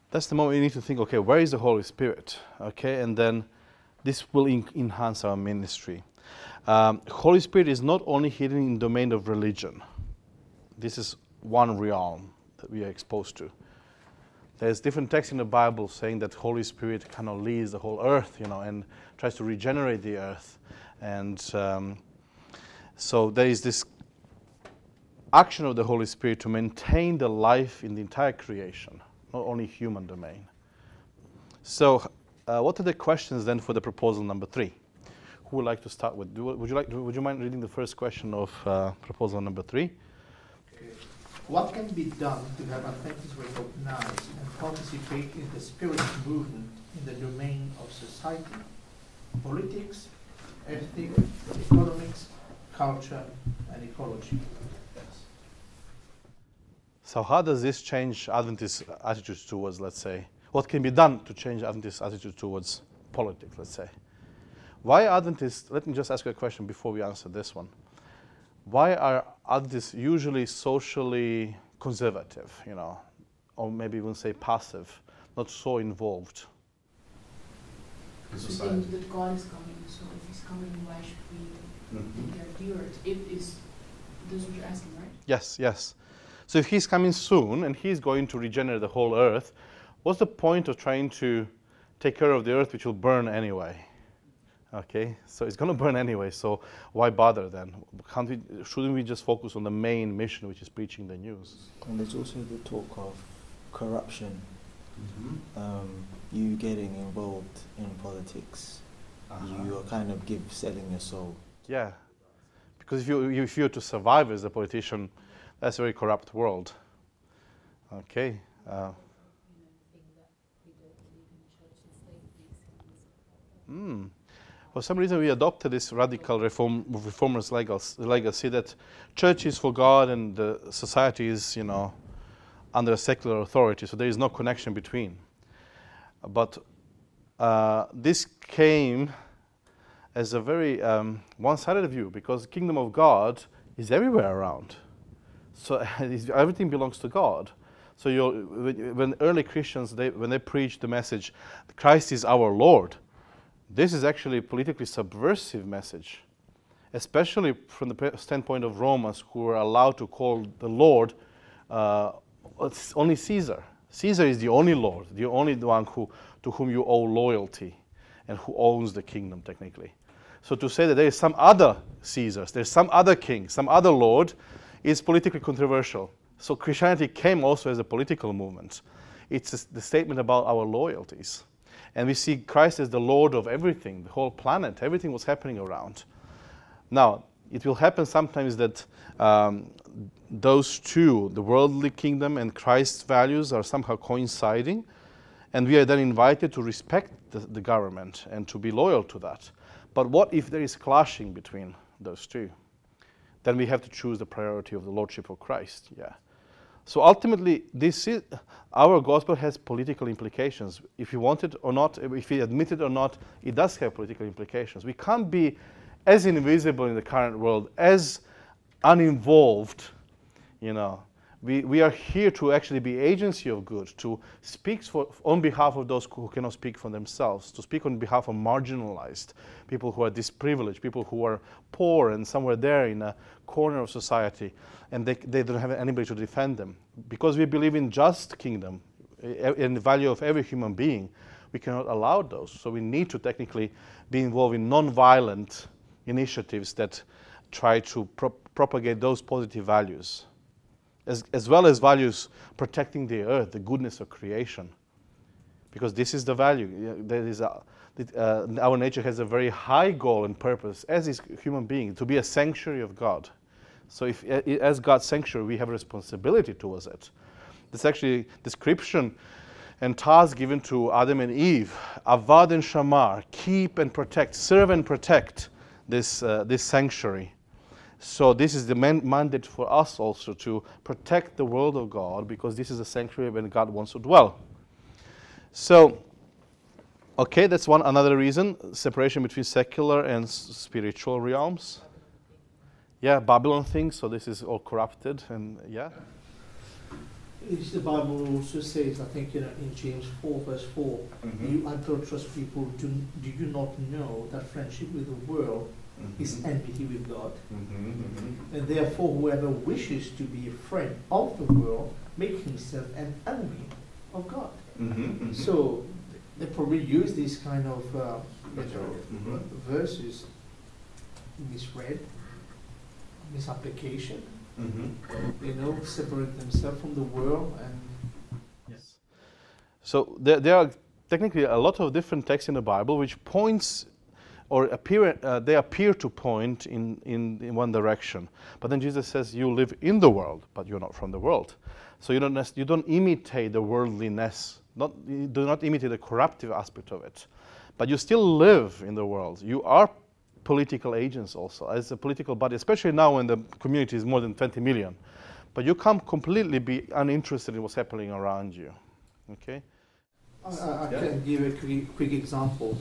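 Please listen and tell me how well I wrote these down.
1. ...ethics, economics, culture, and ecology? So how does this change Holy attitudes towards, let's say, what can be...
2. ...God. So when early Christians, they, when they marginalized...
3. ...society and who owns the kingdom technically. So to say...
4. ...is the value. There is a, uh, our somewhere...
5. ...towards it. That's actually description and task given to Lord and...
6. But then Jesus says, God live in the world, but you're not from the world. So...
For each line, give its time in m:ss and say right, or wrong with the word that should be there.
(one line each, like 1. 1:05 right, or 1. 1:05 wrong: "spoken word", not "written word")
1. 0:50 wrong: "Adventist", not "Holy"
2. 2:27 wrong: "preached", not "marginalized"
3. 2:47 wrong: "loyalty", not "society"
4. 4:16 wrong: "nature", not "somewhere"
5. 4:26 wrong: "Adam", not "Lord"
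6. 5:38 wrong: "You", not "God".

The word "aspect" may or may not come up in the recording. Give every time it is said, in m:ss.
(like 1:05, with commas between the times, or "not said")
5:46.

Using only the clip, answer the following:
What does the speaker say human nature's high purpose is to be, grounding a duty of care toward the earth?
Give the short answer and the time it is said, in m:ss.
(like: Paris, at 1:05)
A sanctuary of God, at 4:22.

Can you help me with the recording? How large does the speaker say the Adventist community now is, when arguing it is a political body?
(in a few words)
More than 20 million.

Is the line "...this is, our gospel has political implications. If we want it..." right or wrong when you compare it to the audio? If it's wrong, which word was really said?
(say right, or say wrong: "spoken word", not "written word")
right.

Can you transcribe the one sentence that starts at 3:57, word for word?
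Because we believe in just kingdom, eh, eh, in the value of every human being, we cannot allow those.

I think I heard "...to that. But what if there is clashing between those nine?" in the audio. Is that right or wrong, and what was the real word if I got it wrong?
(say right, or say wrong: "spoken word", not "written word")
wrong: "two", not "nine".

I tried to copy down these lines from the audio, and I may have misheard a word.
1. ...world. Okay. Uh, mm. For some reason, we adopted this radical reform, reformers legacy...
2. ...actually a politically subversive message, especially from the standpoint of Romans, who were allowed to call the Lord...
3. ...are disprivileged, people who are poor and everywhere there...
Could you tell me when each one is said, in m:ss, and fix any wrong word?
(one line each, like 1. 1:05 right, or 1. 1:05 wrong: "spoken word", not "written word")
1. 1:56 right
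2. 2:34 right
3. 3:50 wrong: "somewhere", not "everywhere".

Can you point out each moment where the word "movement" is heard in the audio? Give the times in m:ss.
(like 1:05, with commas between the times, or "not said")
0:46, 2:58.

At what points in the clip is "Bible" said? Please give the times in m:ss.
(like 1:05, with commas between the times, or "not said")
0:15, 4:57, 5:32.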